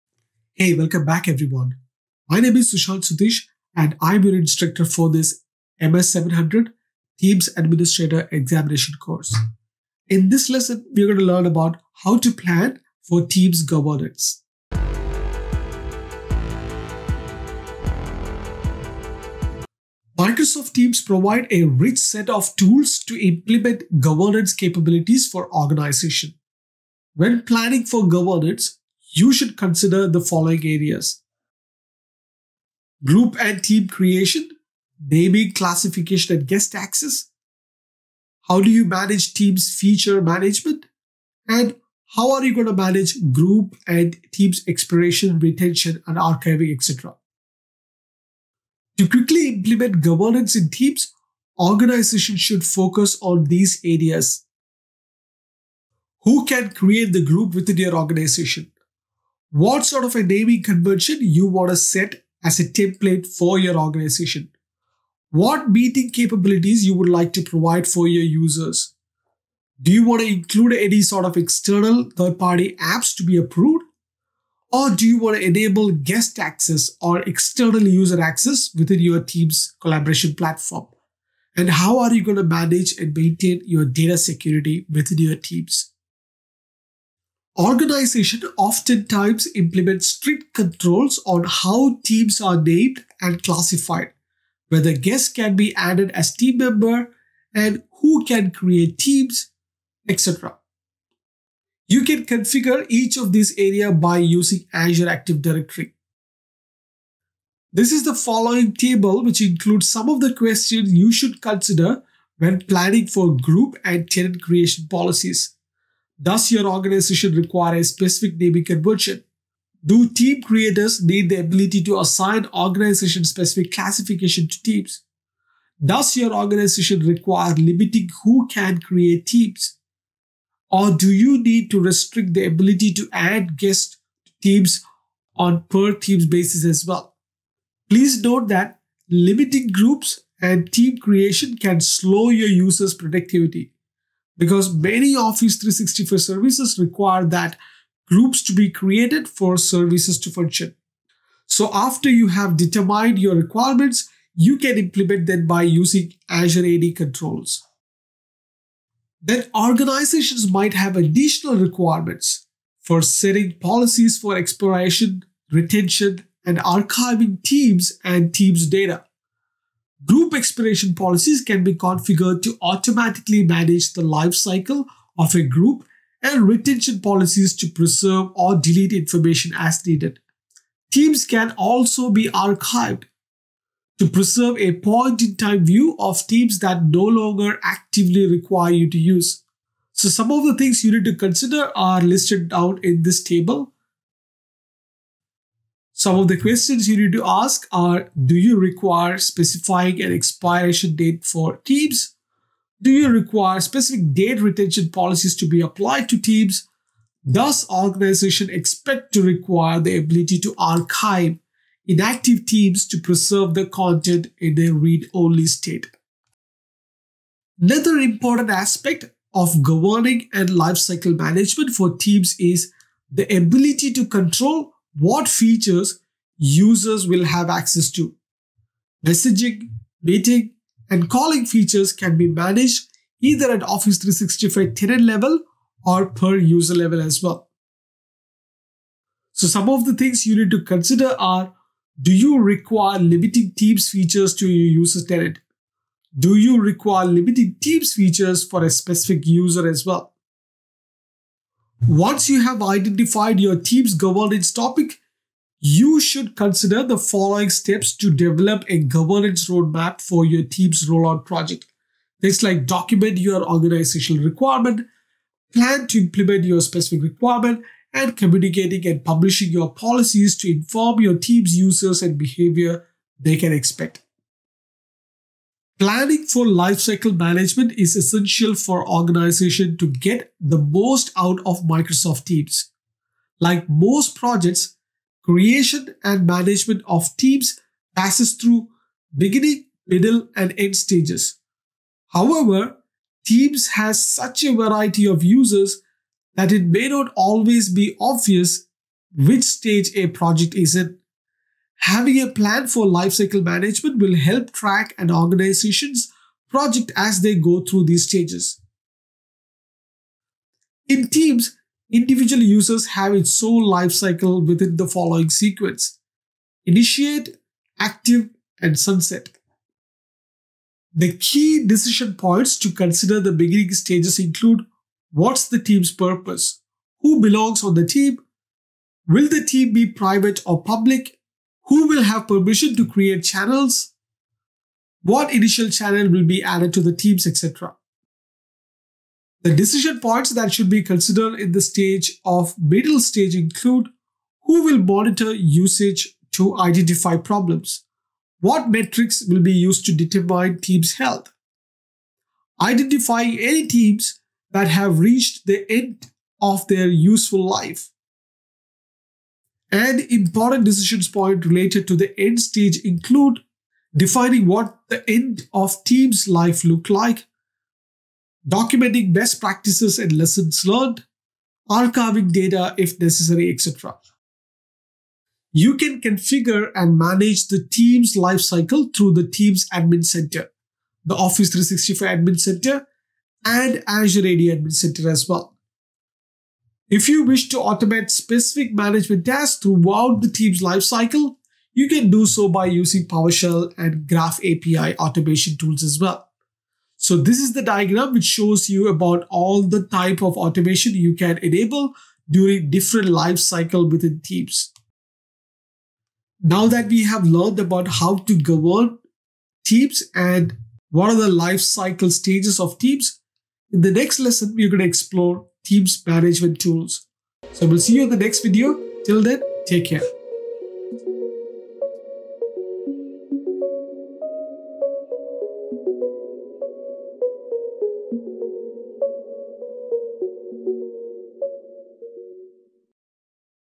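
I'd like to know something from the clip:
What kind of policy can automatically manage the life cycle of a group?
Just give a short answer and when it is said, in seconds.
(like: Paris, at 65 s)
Group expiration policies, at 170 s.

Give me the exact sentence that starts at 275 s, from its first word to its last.
Planning for lifecycle management is essential for organization to get the most out of Microsoft Teams.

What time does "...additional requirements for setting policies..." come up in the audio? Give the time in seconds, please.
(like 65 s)
160 s.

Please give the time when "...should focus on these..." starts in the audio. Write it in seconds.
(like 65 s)
52 s.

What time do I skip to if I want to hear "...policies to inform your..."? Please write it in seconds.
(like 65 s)
269 s.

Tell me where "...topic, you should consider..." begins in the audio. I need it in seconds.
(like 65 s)
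254 s.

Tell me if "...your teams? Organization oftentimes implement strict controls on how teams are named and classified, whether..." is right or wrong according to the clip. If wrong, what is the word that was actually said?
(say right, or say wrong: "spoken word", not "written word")
right.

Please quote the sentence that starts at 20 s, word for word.
Microsoft Teams provide a rich set of tools to implement governance capabilities for organization.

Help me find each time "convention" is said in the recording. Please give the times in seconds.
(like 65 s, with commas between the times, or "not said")
60 s, 118 s.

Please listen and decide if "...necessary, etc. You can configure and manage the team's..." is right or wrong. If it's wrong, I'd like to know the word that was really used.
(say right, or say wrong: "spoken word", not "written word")
right.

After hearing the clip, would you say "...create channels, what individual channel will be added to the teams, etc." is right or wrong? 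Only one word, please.
wrong.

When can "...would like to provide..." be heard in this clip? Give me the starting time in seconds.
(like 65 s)
66 s.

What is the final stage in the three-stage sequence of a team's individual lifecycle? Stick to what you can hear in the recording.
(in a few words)
sunset.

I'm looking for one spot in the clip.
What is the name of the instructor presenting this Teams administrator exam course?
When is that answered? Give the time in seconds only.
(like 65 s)
2 s.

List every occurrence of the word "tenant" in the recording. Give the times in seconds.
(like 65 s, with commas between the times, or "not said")
114 s, 234 s, 245 s.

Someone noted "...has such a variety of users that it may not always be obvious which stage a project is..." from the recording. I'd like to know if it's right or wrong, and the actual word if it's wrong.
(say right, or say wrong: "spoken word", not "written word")
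right.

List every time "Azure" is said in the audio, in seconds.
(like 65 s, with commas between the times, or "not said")
104 s, 156 s, 383 s.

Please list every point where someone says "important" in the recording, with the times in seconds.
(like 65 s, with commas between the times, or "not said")
217 s, 360 s.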